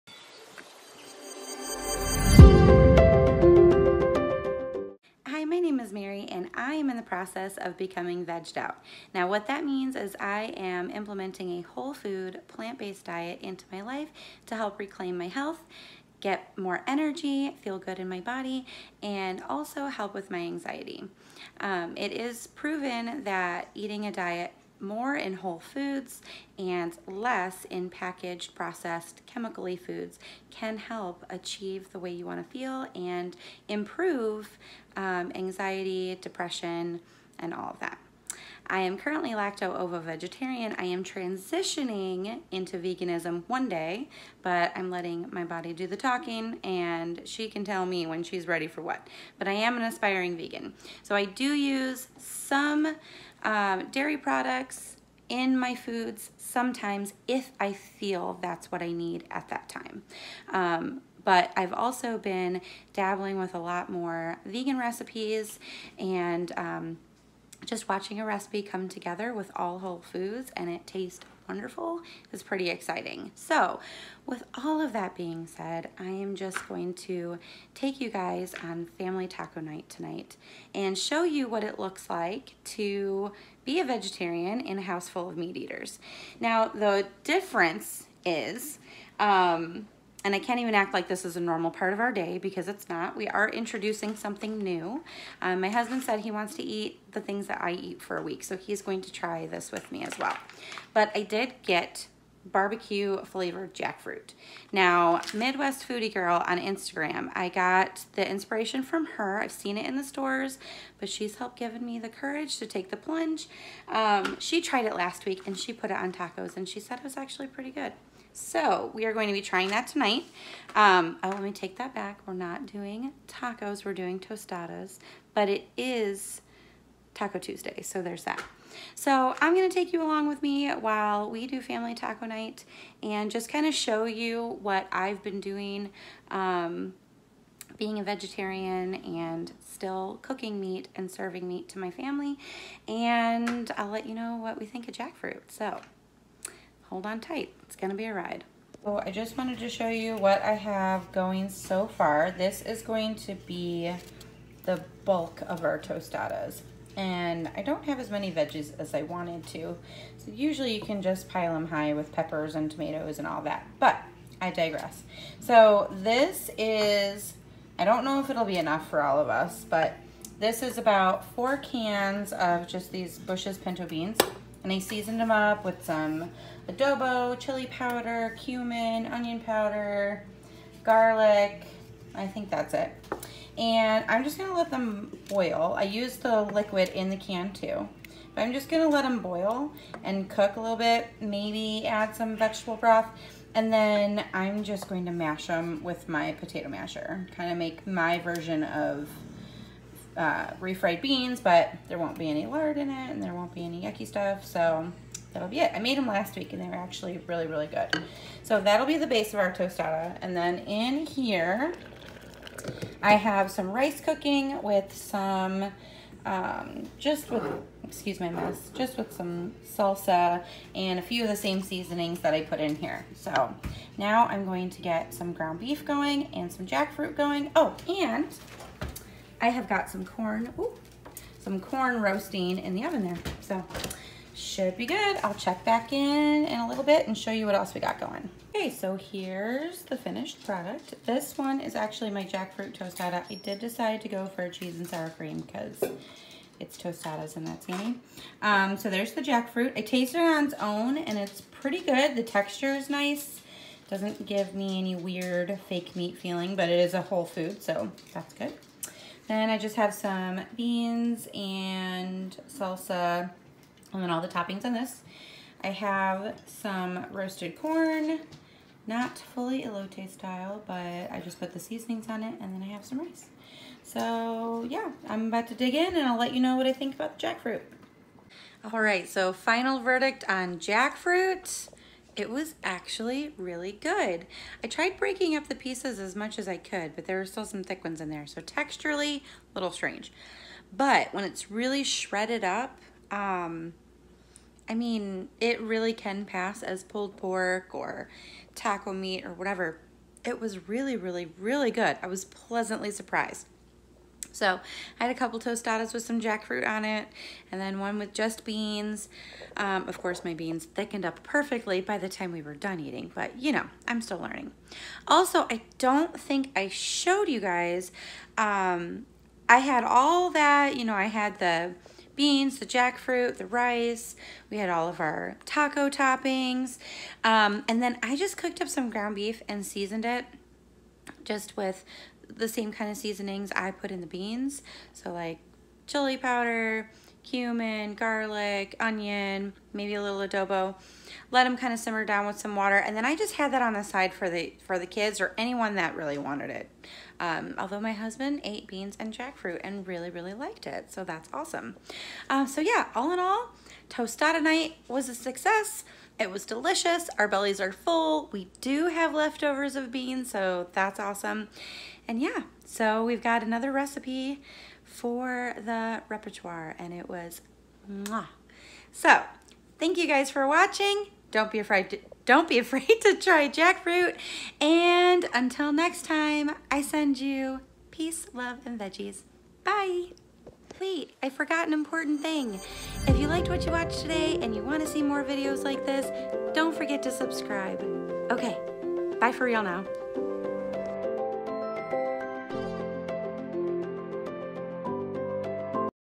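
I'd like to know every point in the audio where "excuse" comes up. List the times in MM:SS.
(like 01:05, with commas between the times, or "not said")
03:37.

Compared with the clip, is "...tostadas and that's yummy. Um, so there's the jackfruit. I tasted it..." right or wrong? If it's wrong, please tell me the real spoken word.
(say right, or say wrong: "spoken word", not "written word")
right.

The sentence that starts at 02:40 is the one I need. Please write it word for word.
So usually you can just pile them high with peppers and tomatoes and all that.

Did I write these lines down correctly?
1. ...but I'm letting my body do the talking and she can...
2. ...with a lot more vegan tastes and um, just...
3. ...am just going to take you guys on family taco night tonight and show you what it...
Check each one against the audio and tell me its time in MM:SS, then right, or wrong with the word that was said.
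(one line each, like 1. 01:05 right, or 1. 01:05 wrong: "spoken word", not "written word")
1. 00:44 right
2. 01:03 wrong: "recipes", not "tastes"
3. 01:16 right.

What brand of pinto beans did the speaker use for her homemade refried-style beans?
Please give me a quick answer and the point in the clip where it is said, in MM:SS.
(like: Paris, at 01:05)
Bush's, at 02:53.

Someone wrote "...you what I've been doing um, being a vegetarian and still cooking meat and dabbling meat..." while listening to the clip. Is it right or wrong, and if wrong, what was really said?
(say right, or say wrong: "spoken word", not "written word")
wrong: "serving", not "dabbling".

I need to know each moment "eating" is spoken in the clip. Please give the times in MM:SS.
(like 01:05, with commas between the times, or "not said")
00:23, 05:12.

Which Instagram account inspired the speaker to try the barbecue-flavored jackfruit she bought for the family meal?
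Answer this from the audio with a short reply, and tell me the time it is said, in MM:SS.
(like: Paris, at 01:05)
Midwest Foodie Girl, at 01:45.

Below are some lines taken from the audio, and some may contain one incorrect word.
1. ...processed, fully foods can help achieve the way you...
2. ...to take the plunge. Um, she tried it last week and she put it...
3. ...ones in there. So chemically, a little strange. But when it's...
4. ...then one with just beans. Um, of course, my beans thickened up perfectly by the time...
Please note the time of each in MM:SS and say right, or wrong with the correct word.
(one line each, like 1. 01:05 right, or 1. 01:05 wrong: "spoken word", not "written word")
1. 00:28 wrong: "chemically", not "fully"
2. 01:52 right
3. 04:47 wrong: "texturally", not "chemically"
4. 05:07 right.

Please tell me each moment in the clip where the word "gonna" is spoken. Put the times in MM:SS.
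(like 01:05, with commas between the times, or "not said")
02:27, 03:04, 03:08.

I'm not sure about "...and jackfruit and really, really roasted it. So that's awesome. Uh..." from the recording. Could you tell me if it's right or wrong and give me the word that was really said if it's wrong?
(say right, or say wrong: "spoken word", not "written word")
wrong: "liked", not "roasted".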